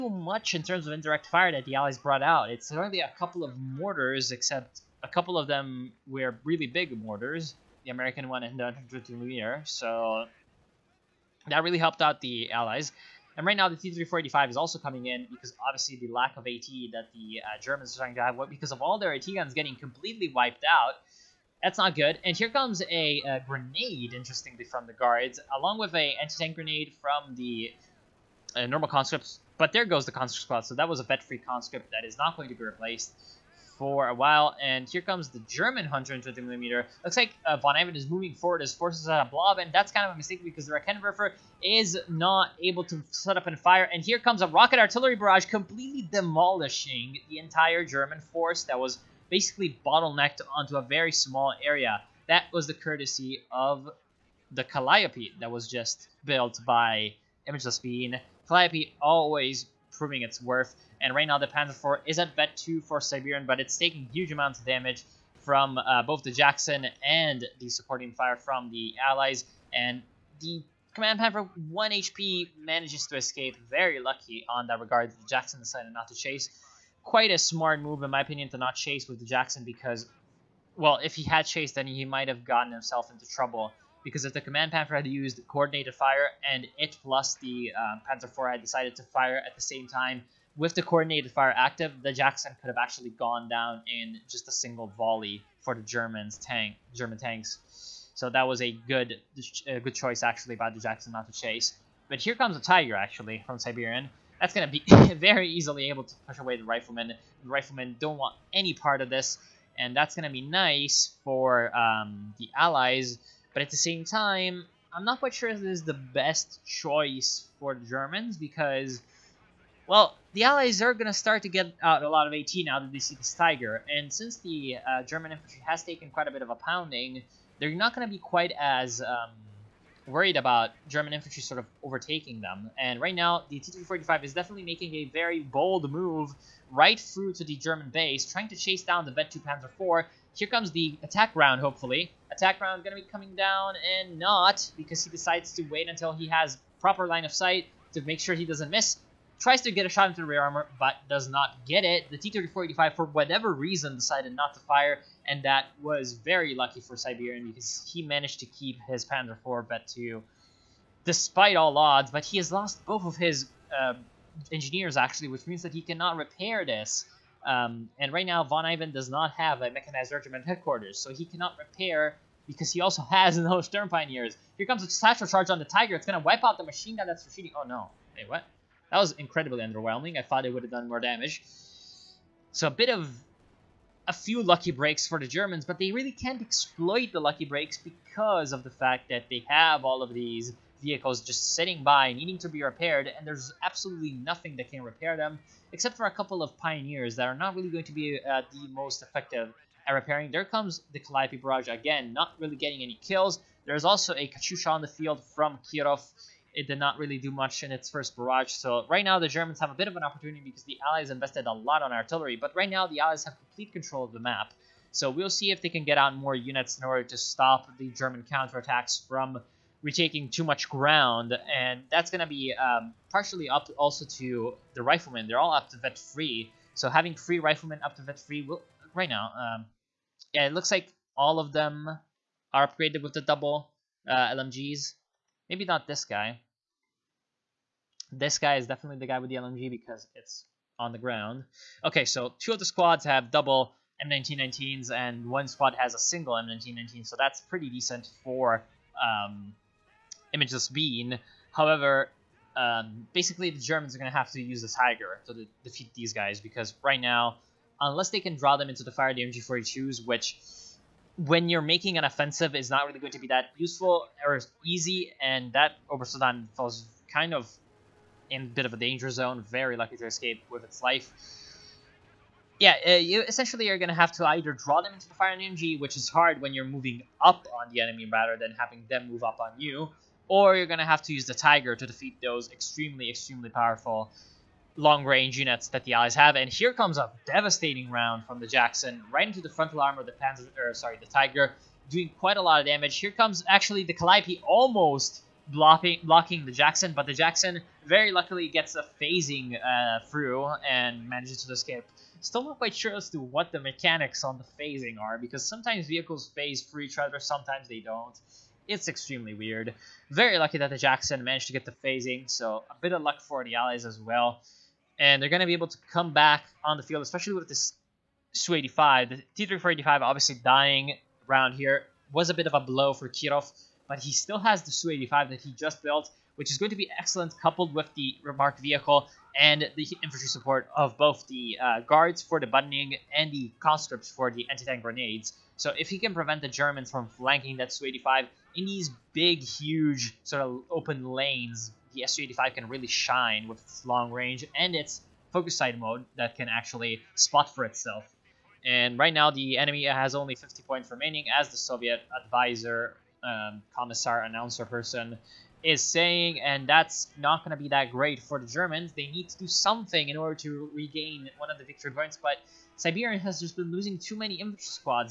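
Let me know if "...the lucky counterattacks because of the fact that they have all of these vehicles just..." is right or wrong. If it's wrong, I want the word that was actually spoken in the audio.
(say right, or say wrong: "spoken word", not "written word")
wrong: "breaks", not "counterattacks".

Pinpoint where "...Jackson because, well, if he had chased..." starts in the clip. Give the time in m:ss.
1:19.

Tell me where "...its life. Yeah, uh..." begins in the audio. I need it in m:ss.
4:30.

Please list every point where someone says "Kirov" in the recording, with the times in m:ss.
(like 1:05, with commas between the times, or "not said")
3:25, 5:23.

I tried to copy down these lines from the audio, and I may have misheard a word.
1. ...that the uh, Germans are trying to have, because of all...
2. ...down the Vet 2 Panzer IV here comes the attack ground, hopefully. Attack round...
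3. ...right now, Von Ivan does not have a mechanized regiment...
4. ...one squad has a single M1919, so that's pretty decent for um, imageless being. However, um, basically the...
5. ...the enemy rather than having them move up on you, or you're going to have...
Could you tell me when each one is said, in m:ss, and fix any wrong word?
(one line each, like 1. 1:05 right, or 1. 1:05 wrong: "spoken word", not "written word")
1. 0:16 right
2. 2:18 wrong: "round", not "ground"
3. 2:48 right
4. 4:05 right
5. 4:37 right.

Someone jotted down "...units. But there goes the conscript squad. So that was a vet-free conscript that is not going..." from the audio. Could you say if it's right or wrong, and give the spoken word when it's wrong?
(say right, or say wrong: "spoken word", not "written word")
wrong: "conscripts", not "units".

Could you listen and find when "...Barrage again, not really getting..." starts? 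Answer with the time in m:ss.
3:21.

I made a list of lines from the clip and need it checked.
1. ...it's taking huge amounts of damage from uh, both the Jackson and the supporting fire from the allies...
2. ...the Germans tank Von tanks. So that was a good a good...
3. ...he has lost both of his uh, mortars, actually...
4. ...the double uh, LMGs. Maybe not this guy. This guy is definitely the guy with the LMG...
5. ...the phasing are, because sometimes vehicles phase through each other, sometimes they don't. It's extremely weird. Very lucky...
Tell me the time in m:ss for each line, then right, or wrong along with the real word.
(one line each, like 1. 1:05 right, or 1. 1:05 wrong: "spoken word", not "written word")
1. 1:03 right
2. 1:35 wrong: "German", not "Von"
3. 2:42 wrong: "engineers", not "mortars"
4. 3:53 right
5. 5:04 right.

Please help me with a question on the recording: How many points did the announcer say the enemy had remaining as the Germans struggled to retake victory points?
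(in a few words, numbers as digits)
50.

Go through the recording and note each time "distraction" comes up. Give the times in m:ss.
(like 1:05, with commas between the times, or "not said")
not said.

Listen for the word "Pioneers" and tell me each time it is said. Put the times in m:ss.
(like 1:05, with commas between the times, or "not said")
2:53, 3:16.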